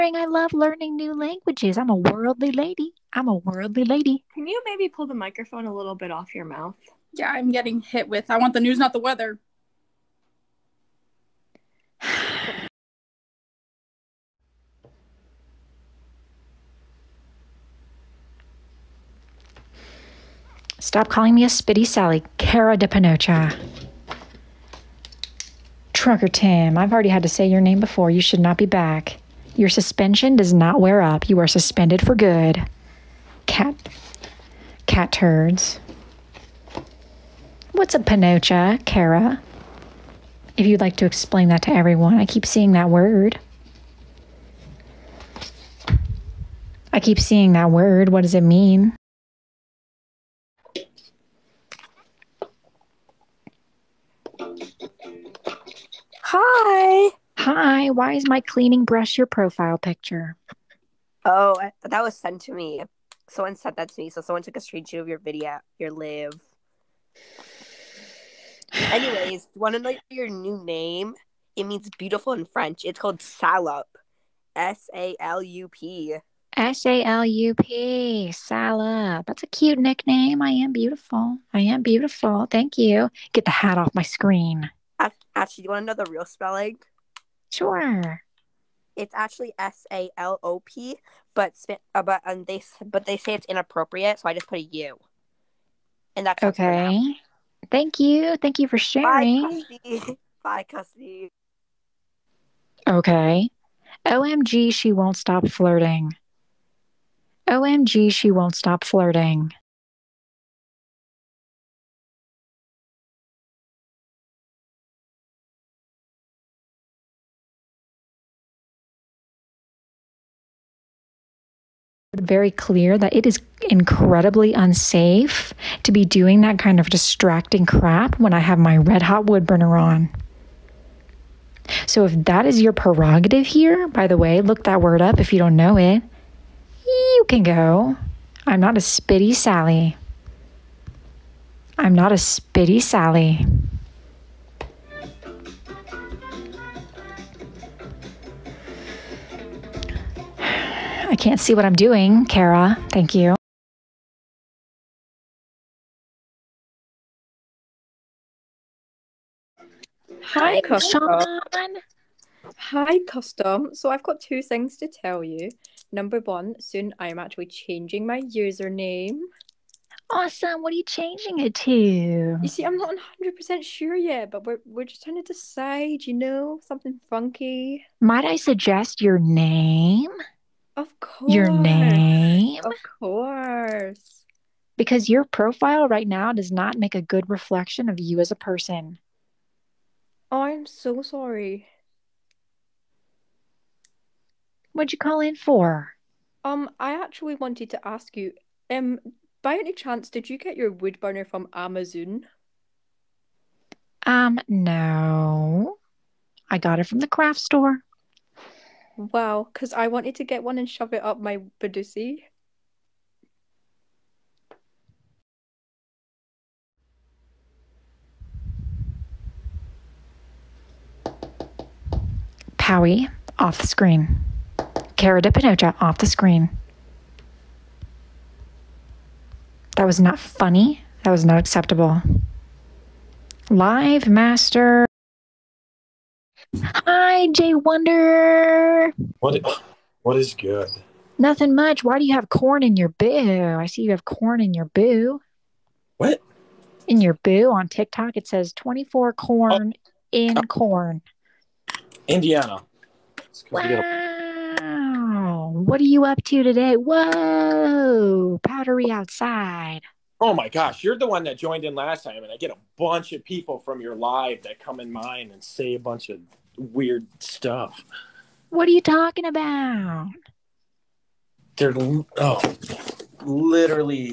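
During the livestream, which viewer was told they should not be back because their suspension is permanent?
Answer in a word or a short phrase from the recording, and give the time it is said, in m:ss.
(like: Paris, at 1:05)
Trucker Tim, at 0:25.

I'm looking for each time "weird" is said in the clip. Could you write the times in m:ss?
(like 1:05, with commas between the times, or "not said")
4:26.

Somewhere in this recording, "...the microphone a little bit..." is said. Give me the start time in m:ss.
0:05.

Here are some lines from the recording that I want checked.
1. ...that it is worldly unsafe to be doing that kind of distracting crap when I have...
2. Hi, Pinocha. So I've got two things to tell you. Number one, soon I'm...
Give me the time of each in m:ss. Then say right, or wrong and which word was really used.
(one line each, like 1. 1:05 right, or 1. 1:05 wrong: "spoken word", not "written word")
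1. 2:02 wrong: "incredibly", not "worldly"
2. 2:42 wrong: "Custom", not "Pinocha".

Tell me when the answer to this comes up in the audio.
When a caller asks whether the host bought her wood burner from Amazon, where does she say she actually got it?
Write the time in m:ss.
3:26.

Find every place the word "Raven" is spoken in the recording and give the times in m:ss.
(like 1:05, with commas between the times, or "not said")
not said.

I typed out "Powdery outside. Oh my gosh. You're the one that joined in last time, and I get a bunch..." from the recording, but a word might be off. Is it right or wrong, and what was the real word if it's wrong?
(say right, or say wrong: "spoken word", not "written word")
right.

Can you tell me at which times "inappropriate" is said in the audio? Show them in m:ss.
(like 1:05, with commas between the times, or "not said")
1:33.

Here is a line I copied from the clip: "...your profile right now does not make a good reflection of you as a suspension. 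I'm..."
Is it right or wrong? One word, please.
wrong.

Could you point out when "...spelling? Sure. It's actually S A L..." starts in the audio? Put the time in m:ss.
1:26.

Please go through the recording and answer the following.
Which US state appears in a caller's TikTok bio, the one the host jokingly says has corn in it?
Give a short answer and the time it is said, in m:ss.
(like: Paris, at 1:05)
Indiana, at 4:12.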